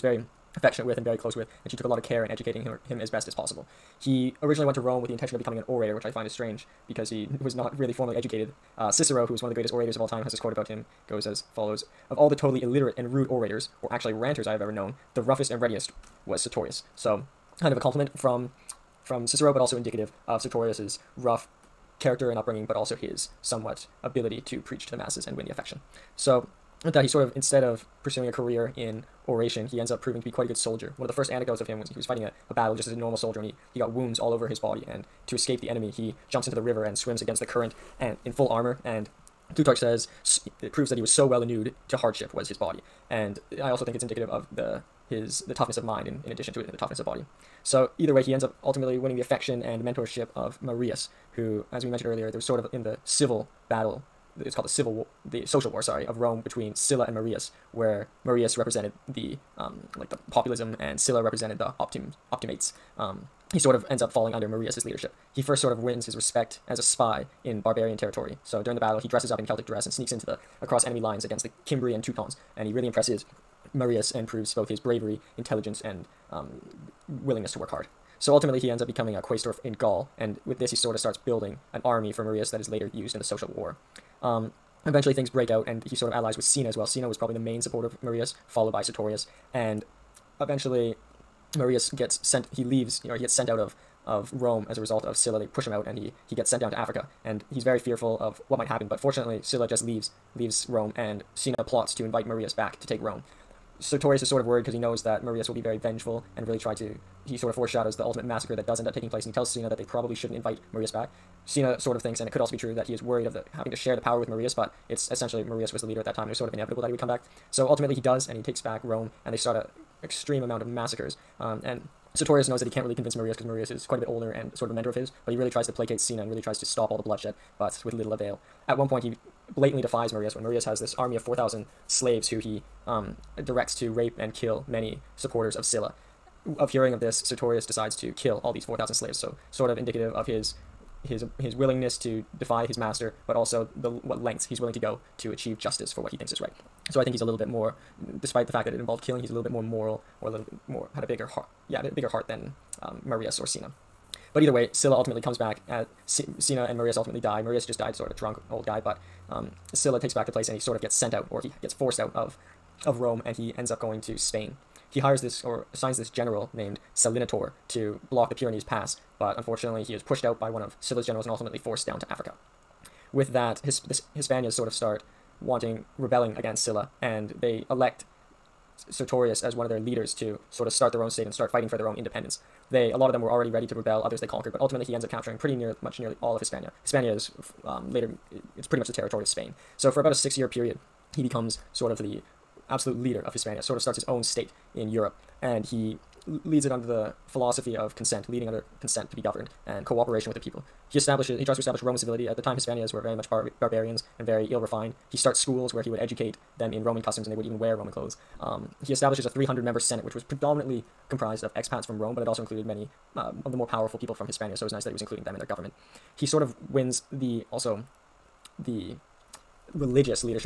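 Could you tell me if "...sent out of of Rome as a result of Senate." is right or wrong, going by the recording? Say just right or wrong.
wrong.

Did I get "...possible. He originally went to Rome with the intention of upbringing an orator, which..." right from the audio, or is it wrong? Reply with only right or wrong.
wrong.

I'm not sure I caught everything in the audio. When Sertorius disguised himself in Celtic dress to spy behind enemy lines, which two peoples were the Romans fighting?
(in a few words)
Cimbri and Teutons.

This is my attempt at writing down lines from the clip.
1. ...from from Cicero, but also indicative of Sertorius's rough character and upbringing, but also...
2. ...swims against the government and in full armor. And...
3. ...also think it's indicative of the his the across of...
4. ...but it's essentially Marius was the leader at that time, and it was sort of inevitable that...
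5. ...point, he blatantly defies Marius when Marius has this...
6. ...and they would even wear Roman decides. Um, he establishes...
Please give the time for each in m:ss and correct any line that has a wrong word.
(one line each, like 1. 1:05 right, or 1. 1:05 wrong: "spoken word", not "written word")
1. 0:18 right
2. 0:36 wrong: "current", not "government"
3. 0:43 wrong: "toughness", not "across"
4. 1:54 right
5. 2:08 right
6. 3:27 wrong: "clothes", not "decides".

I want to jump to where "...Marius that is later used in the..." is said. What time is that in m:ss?
1:22.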